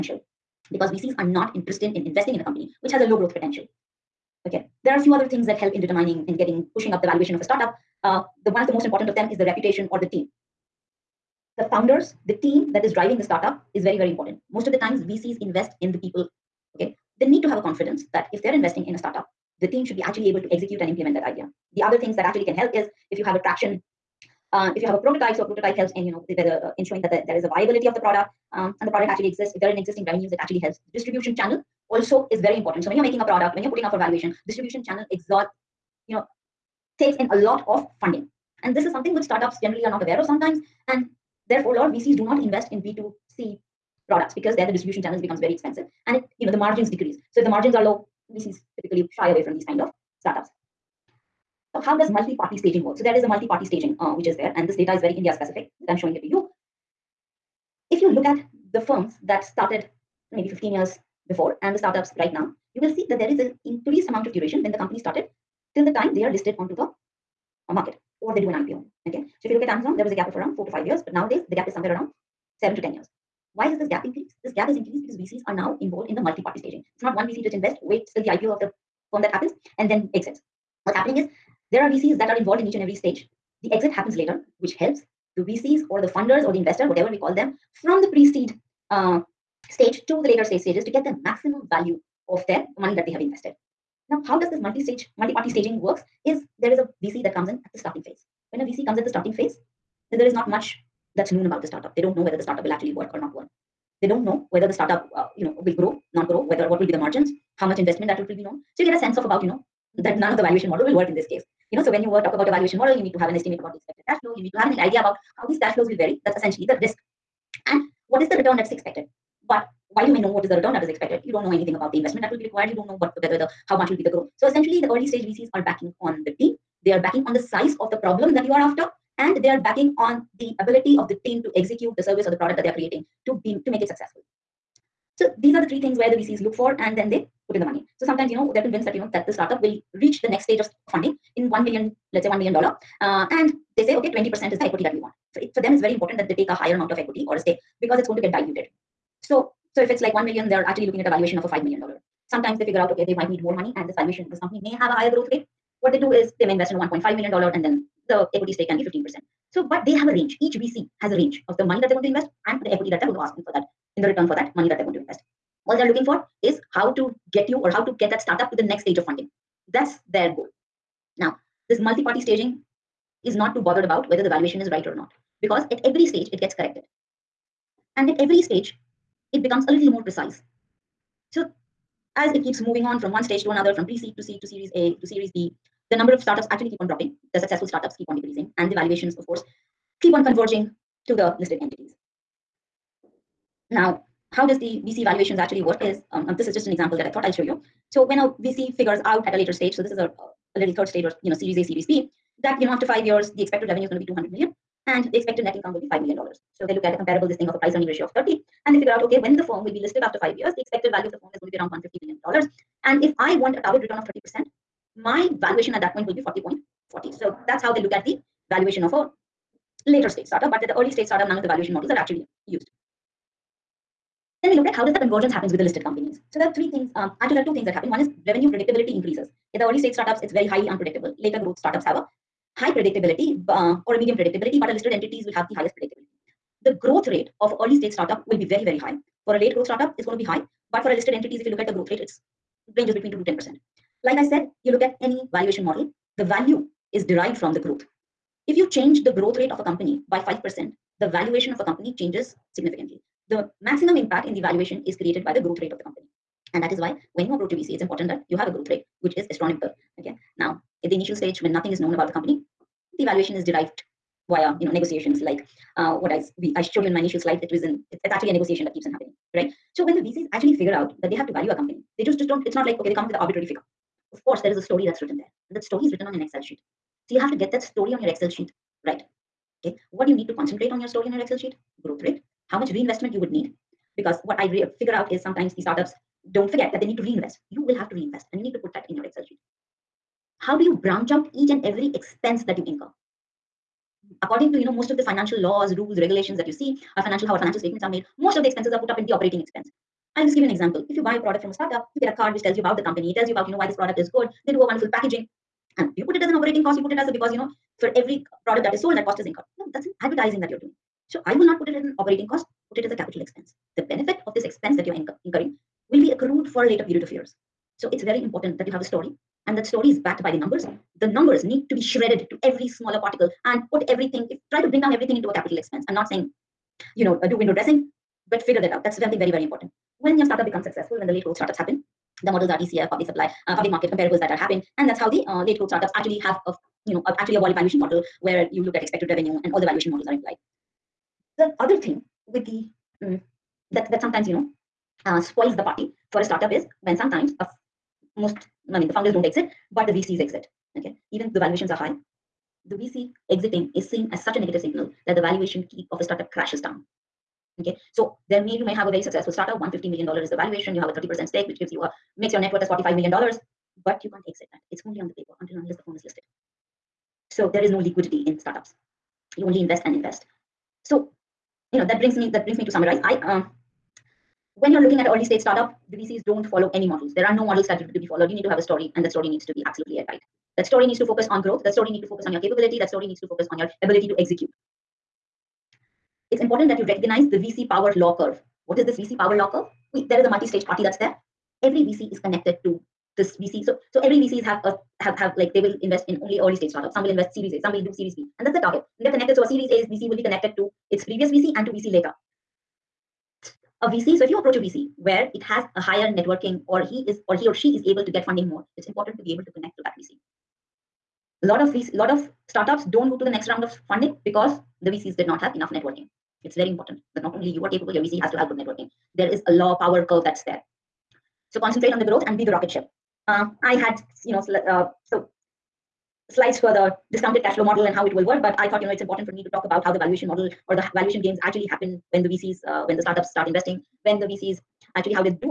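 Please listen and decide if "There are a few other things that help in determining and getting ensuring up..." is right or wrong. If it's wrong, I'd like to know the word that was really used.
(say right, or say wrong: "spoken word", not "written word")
wrong: "pushing", not "ensuring".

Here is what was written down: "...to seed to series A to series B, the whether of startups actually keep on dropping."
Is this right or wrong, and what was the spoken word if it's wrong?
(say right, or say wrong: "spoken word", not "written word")
wrong: "number", not "whether".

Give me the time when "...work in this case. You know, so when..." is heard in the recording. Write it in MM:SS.
01:50.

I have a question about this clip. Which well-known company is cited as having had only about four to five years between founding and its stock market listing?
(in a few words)
Amazon.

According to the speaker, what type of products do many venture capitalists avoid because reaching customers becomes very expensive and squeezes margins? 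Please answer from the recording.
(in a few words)
B2C products.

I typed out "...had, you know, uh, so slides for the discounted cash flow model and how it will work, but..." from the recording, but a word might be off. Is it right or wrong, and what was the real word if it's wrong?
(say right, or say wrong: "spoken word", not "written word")
right.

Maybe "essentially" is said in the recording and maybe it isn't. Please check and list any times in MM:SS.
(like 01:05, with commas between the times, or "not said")
01:56, 02:04.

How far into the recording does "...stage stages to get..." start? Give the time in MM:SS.
01:30.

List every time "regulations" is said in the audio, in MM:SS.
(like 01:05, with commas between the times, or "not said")
04:55.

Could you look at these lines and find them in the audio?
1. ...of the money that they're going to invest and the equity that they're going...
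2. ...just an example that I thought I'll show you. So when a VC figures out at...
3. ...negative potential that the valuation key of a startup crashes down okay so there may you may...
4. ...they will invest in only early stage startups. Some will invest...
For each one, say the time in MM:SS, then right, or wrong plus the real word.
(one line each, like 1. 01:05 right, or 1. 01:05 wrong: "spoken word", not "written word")
1. 02:41 right
2. 03:16 right
3. 05:54 wrong: "signal", not "potential"
4. 06:35 right.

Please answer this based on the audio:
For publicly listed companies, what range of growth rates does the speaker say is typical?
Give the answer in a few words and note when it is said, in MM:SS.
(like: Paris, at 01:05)
2 to 10 percent, at 04:03.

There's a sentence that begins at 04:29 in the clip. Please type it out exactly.
So when the VCs actually figure out that they have to value a company, they just just don't.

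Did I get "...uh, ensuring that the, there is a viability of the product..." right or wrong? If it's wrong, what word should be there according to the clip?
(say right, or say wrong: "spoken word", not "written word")
right.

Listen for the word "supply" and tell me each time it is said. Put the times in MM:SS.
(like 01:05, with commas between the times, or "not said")
05:33.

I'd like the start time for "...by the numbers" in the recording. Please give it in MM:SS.
05:20.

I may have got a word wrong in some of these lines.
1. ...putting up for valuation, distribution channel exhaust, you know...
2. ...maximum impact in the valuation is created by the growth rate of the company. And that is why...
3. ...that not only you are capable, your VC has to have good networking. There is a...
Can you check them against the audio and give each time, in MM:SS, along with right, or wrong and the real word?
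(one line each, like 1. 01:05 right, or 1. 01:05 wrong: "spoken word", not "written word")
1. 00:33 right
2. 04:13 right
3. 06:57 right.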